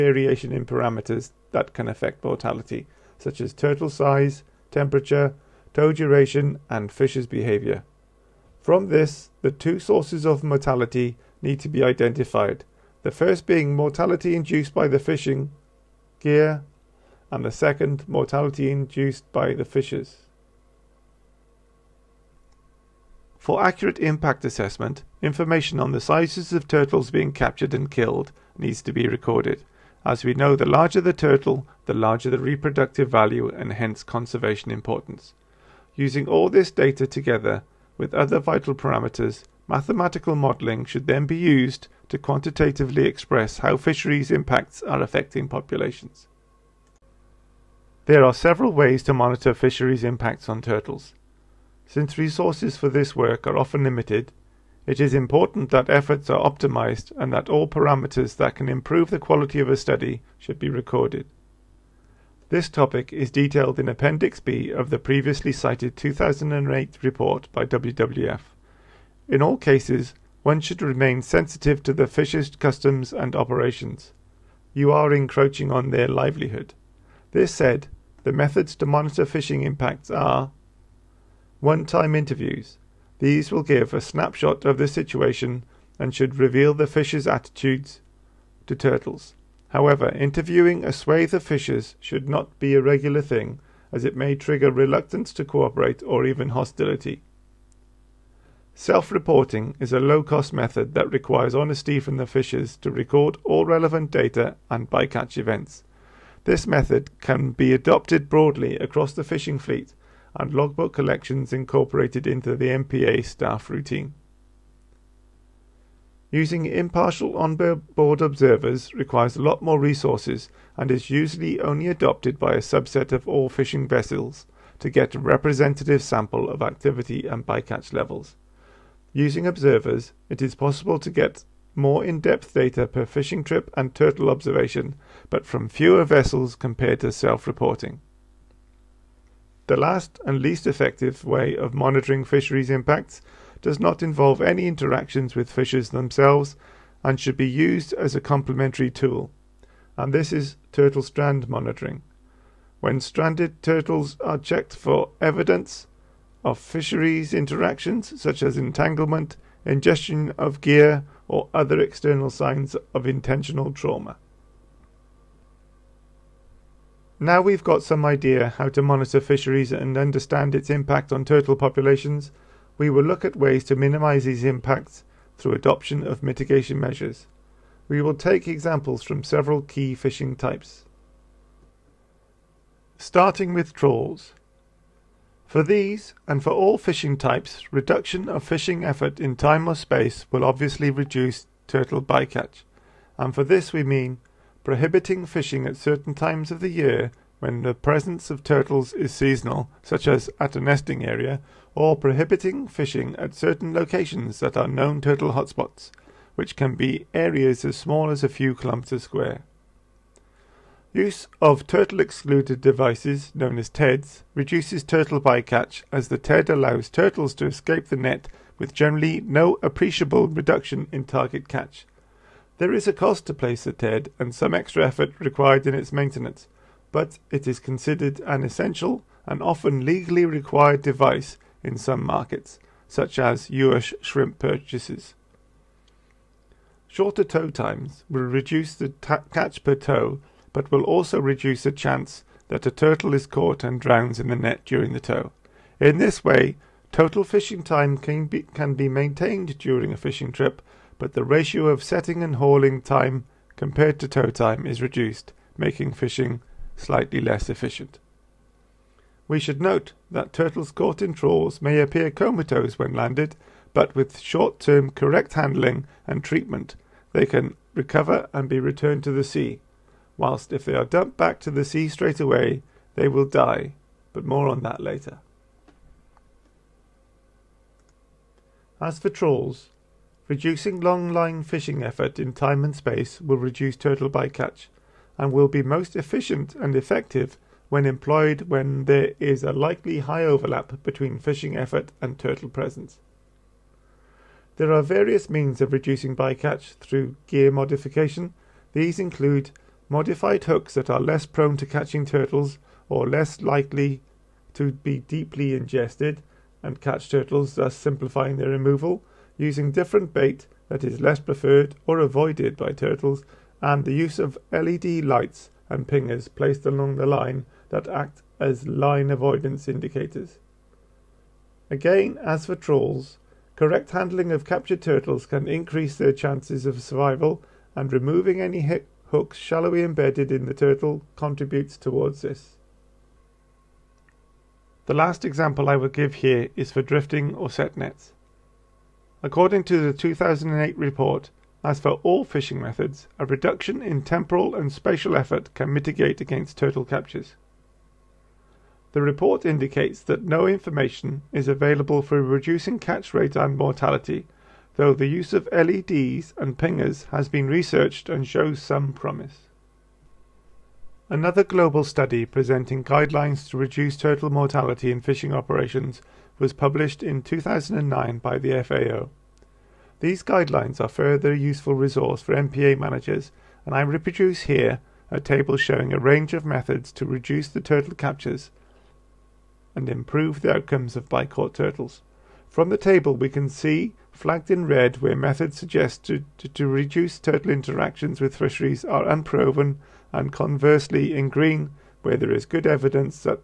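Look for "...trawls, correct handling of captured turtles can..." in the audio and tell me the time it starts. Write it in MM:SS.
05:22.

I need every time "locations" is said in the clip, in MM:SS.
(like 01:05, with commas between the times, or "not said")
03:23.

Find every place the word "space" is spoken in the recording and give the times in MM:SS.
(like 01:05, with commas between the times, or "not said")
03:09, 04:42.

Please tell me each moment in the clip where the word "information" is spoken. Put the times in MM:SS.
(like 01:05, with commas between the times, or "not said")
00:25, 05:50.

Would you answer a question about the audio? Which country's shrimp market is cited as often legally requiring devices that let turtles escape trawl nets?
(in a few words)
US.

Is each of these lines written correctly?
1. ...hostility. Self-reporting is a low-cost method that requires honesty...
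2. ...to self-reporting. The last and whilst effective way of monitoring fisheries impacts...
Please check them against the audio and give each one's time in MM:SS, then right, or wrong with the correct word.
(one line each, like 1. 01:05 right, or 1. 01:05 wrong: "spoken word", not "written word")
1. 01:36 right
2. 02:17 wrong: "least", not "whilst".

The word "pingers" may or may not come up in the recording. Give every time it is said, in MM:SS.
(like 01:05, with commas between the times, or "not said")
05:15, 05:56.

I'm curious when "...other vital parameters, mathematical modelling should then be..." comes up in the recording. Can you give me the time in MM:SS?
00:38.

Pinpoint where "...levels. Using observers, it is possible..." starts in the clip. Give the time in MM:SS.
02:07.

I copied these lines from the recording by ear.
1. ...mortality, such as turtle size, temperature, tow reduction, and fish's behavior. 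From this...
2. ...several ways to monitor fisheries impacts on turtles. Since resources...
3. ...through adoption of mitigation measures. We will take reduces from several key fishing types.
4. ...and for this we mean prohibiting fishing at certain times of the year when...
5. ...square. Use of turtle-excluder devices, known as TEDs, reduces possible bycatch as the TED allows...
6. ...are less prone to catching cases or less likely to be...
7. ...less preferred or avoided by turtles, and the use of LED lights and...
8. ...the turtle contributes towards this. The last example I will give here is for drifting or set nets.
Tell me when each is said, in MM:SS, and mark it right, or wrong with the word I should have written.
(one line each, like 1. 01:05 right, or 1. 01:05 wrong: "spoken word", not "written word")
1. 00:02 wrong: "duration", not "reduction"
2. 00:48 right
3. 02:55 wrong: "examples", not "reduces"
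4. 03:13 right
5. 03:29 wrong: "turtle", not "possible"
6. 05:00 wrong: "turtles", not "cases"
7. 05:11 right
8. 05:30 right.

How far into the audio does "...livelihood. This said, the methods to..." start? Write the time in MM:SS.
01:16.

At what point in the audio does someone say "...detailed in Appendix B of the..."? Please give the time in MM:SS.
01:03.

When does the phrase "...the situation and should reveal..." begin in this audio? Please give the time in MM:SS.
01:24.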